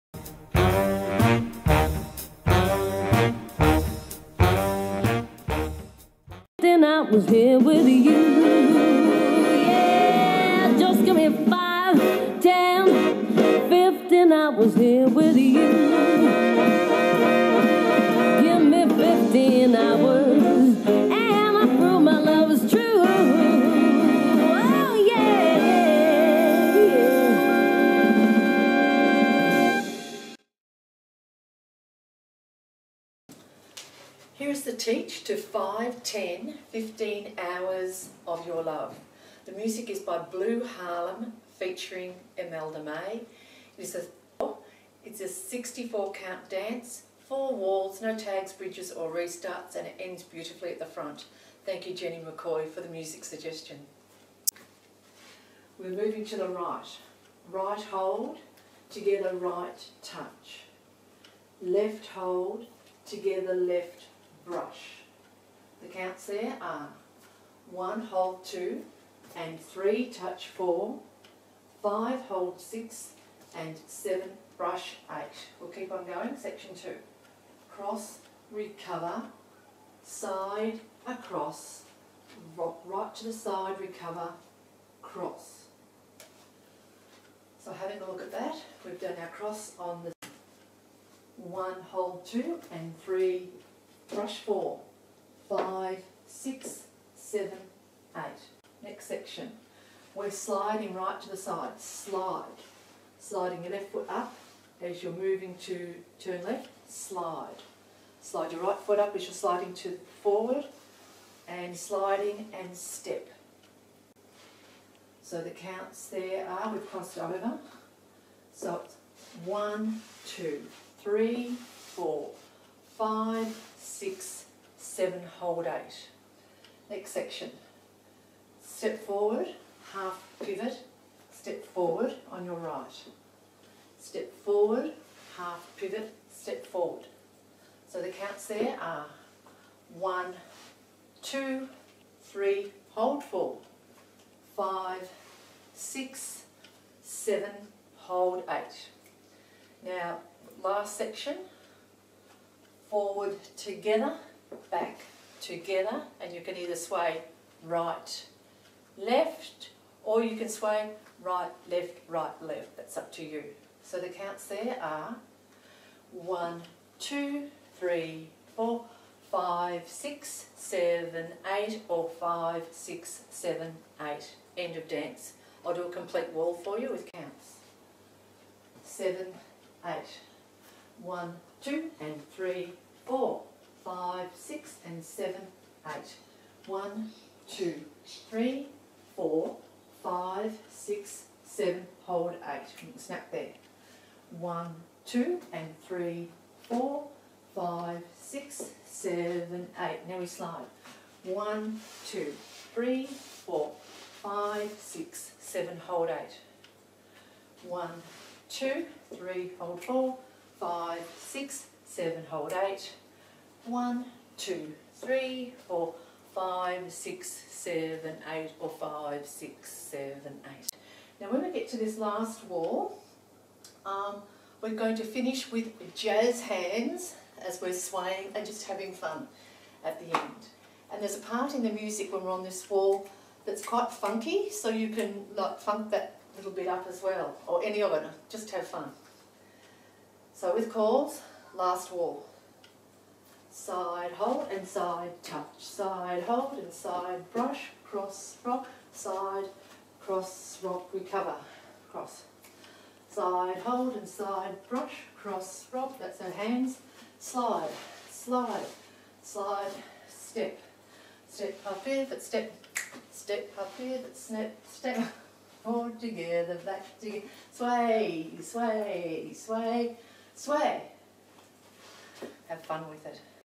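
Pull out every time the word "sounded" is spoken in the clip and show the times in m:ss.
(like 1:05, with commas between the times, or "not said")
not said.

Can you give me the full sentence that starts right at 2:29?
Now, last section, forward together, back together, and you can either sway right, left, or you can sway right, left, right, left.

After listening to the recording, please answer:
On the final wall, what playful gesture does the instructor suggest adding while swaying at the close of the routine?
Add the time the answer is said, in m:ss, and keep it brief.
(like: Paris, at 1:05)
jazz hands, at 3:45.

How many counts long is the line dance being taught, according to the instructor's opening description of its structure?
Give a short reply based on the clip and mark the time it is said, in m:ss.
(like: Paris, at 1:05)
64, at 0:45.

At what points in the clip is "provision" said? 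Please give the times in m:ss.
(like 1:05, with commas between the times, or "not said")
not said.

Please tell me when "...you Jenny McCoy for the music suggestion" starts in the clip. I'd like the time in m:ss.
0:51.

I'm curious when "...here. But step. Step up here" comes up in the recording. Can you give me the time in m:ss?
4:21.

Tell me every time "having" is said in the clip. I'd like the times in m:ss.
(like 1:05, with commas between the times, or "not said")
1:27, 3:48.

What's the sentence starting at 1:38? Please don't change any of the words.
Next section, we're sliding right to the side, slide.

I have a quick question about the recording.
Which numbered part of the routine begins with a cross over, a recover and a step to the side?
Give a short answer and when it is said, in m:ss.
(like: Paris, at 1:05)
Section 2, at 1:16.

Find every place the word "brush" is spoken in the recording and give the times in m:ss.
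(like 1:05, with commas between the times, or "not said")
1:04, 1:14, 1:34, 4:07, 4:14.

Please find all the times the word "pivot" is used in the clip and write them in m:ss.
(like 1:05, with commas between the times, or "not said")
2:10, 2:15.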